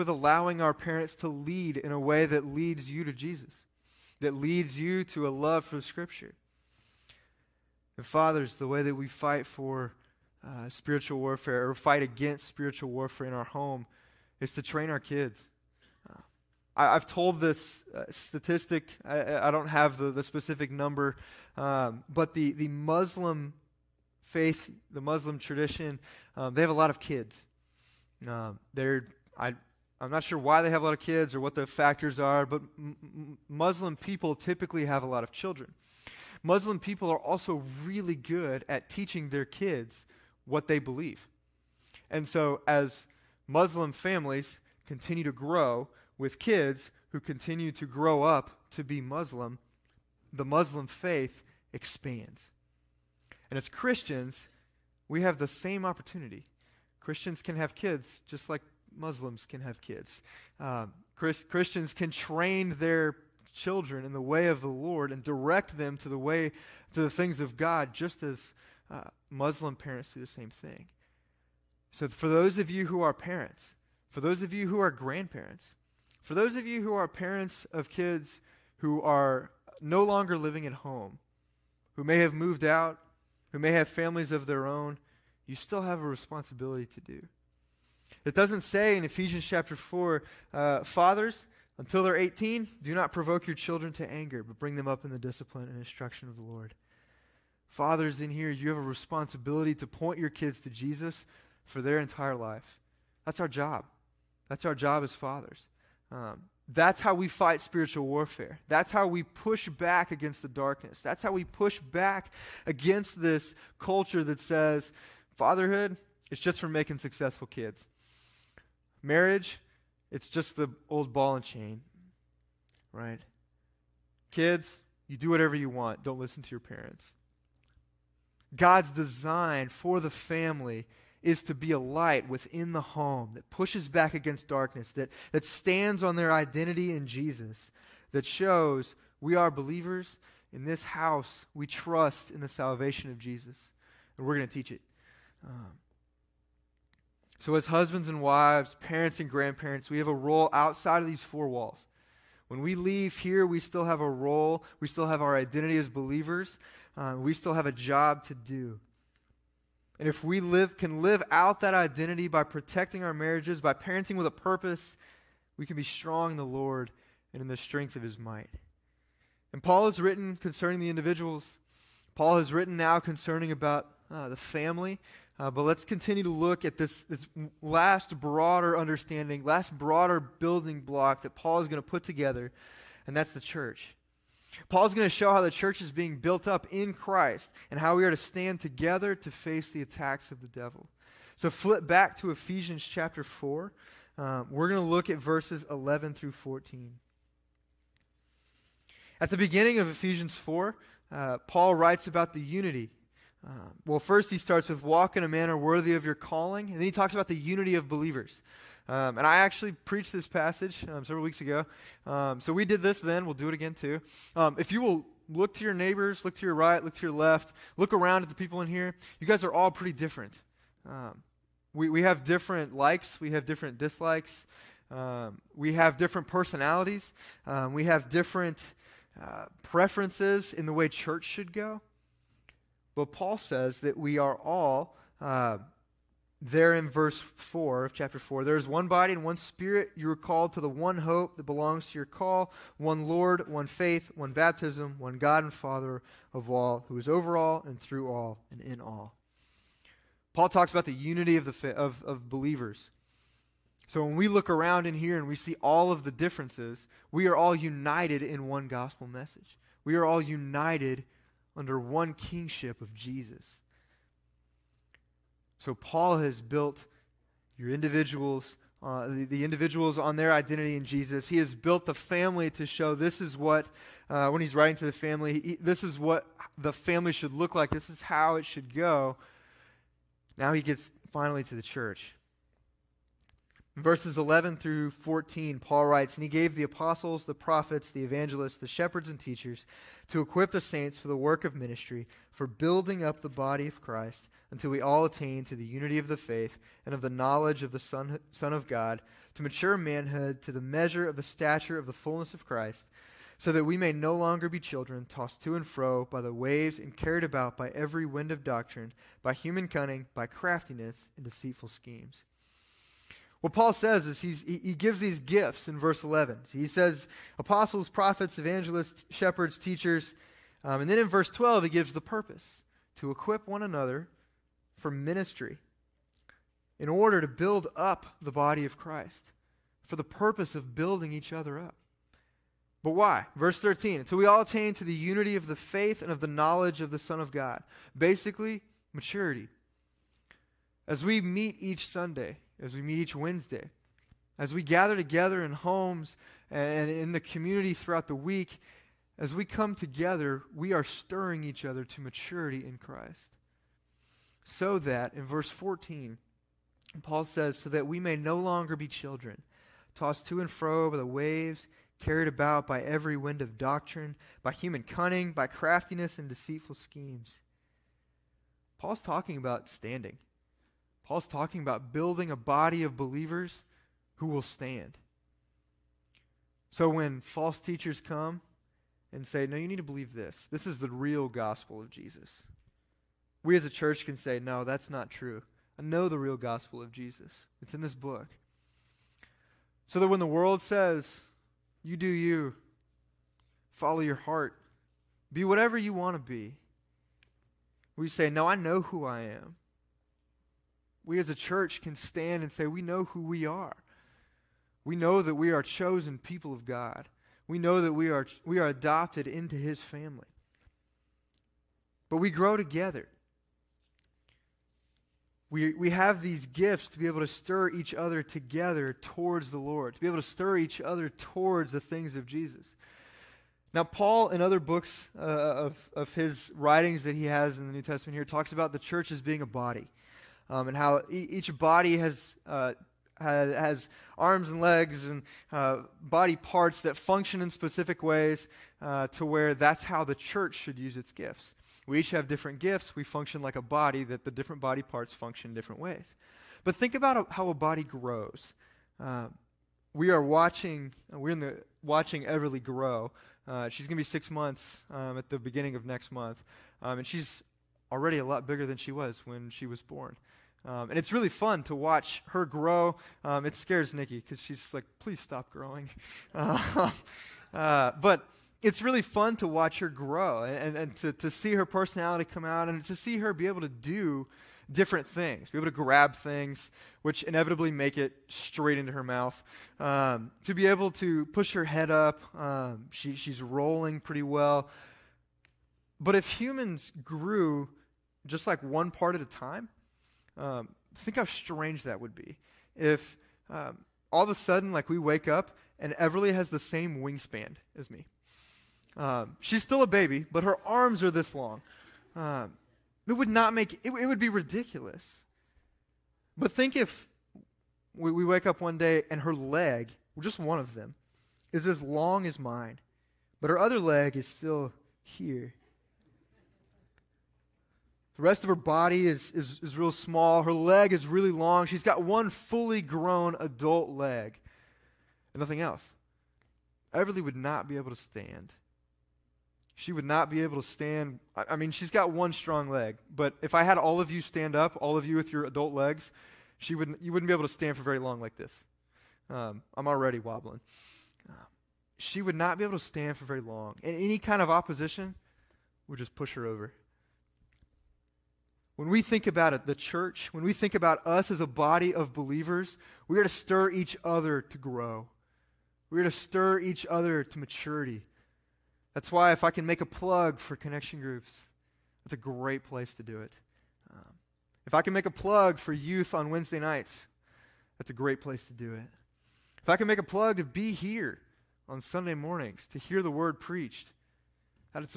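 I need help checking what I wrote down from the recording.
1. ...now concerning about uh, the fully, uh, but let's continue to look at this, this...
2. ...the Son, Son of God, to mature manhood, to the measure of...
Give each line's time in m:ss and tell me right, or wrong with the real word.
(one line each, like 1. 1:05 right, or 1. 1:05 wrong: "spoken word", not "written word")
1. 2:52 wrong: "family", not "fully"
2. 4:57 right.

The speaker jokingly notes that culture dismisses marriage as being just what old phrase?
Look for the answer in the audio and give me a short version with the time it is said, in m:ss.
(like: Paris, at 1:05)
old ball and chain, at 2:00.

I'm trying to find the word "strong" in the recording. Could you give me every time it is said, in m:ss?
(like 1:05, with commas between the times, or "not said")
2:45, 8:52.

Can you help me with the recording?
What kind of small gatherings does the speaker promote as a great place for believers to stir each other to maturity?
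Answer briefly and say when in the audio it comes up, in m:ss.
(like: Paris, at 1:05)
connection groups, at 9:20.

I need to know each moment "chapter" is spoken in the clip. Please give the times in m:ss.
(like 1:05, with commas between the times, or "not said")
1:29, 3:12, 3:57.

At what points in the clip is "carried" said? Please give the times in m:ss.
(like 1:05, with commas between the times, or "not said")
5:06, 6:01.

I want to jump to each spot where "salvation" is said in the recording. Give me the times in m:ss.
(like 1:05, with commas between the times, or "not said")
2:22.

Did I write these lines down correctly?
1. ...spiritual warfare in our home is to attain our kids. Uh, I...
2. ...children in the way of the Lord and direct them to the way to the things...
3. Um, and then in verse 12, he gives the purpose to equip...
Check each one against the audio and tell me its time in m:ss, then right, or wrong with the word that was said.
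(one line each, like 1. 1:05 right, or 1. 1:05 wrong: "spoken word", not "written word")
1. 0:12 wrong: "train", not "attain"
2. 1:03 right
3. 5:20 right.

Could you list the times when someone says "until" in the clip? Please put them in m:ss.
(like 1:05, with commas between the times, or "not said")
1:31, 4:54, 5:33.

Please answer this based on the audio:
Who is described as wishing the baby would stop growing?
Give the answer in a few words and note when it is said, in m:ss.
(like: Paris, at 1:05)
Nikki, at 7:43.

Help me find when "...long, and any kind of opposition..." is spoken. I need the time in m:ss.
9:03.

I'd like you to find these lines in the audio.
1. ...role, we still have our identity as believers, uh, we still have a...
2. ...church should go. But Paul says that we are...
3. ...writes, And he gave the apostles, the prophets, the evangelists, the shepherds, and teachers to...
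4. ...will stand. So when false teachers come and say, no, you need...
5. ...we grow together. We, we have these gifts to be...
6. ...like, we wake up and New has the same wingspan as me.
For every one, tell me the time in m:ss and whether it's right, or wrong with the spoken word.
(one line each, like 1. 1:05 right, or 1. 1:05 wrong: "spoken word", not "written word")
1. 2:34 right
2. 3:50 right
3. 4:45 right
4. 6:14 right
5. 6:52 right
6. 8:14 wrong: "Everly", not "New".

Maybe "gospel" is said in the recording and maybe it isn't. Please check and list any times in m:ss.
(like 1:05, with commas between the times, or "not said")
4:18, 6:21, 6:26.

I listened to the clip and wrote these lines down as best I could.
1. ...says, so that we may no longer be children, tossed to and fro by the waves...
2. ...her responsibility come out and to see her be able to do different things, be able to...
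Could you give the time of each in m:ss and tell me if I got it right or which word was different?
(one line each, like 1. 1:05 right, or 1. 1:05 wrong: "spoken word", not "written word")
1. 5:57 right
2. 7:51 wrong: "personality", not "responsibility".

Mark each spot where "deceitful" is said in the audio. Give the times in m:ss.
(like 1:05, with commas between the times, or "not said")
5:11, 6:06.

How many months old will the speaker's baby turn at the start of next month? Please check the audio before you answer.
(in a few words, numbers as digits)
6.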